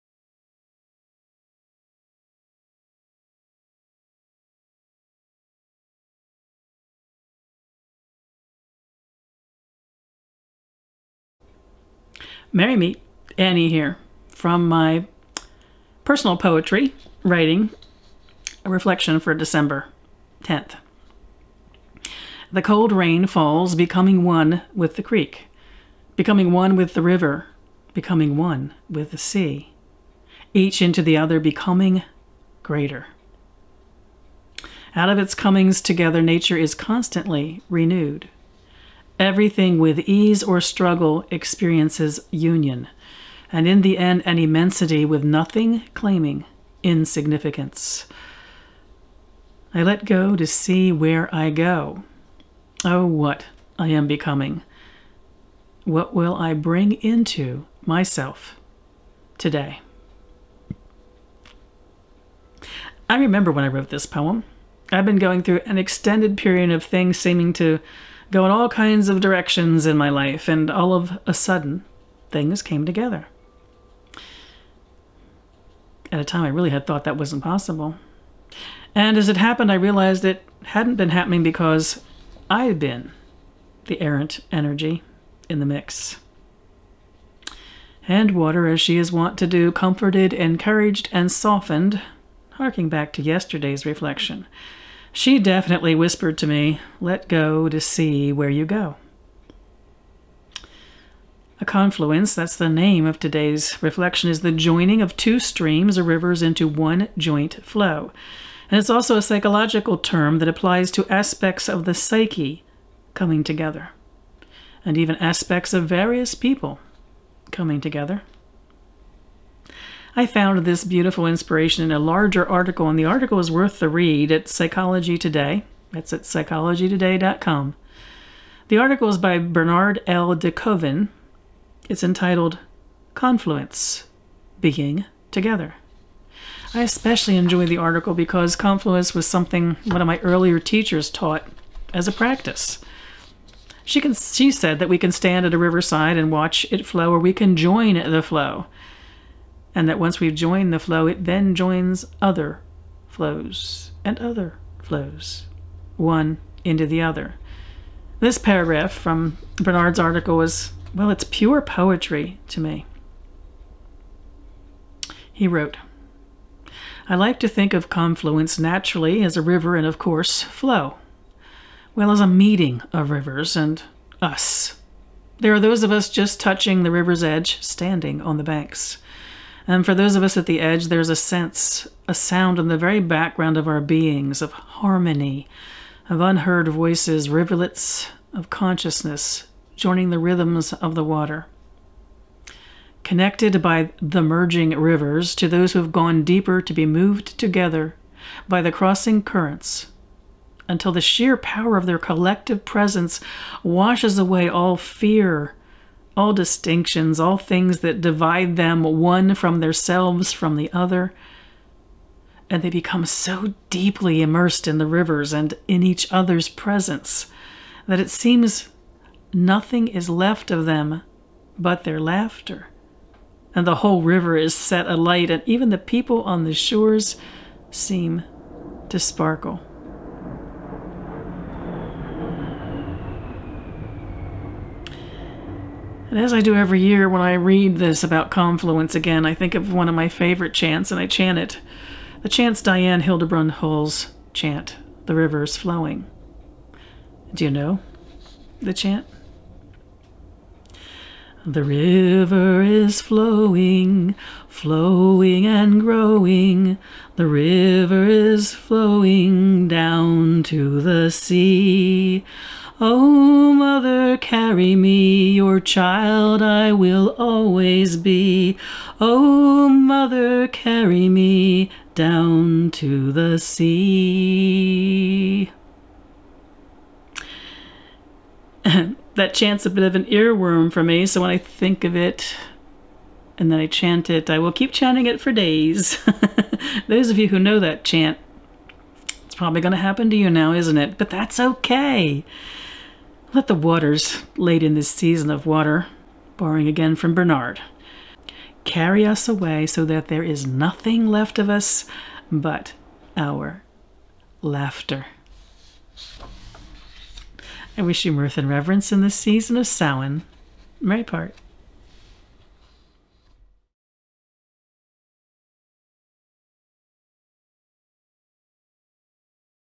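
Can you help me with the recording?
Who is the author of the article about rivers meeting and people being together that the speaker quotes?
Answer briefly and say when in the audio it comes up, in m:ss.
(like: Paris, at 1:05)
Bernard L. DeKoven, at 2:09.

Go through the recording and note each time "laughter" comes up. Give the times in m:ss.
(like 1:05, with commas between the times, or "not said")
3:41, 5:04.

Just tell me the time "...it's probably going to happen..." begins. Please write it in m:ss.
4:49.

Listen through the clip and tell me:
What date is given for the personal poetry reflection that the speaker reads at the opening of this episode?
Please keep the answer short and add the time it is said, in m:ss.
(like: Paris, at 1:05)
December 10th, at 0:19.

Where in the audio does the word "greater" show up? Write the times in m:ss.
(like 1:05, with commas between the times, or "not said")
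0:32.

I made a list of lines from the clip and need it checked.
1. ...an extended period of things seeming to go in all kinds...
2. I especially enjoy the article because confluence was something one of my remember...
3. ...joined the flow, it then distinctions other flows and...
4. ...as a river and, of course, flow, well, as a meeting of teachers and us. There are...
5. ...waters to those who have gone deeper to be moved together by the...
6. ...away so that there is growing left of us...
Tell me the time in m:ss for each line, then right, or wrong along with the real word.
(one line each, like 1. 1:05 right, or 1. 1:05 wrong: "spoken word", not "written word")
1. 1:05 right
2. 2:16 wrong: "earlier", not "remember"
3. 2:30 wrong: "joins", not "distinctions"
4. 2:49 wrong: "rivers", not "teachers"
5. 3:14 wrong: "rivers", not "waters"
6. 4:59 wrong: "nothing", not "growing".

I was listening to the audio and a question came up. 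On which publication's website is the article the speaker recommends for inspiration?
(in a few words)
Psychology Today.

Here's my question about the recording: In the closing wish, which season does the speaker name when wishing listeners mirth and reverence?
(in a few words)
Samhain.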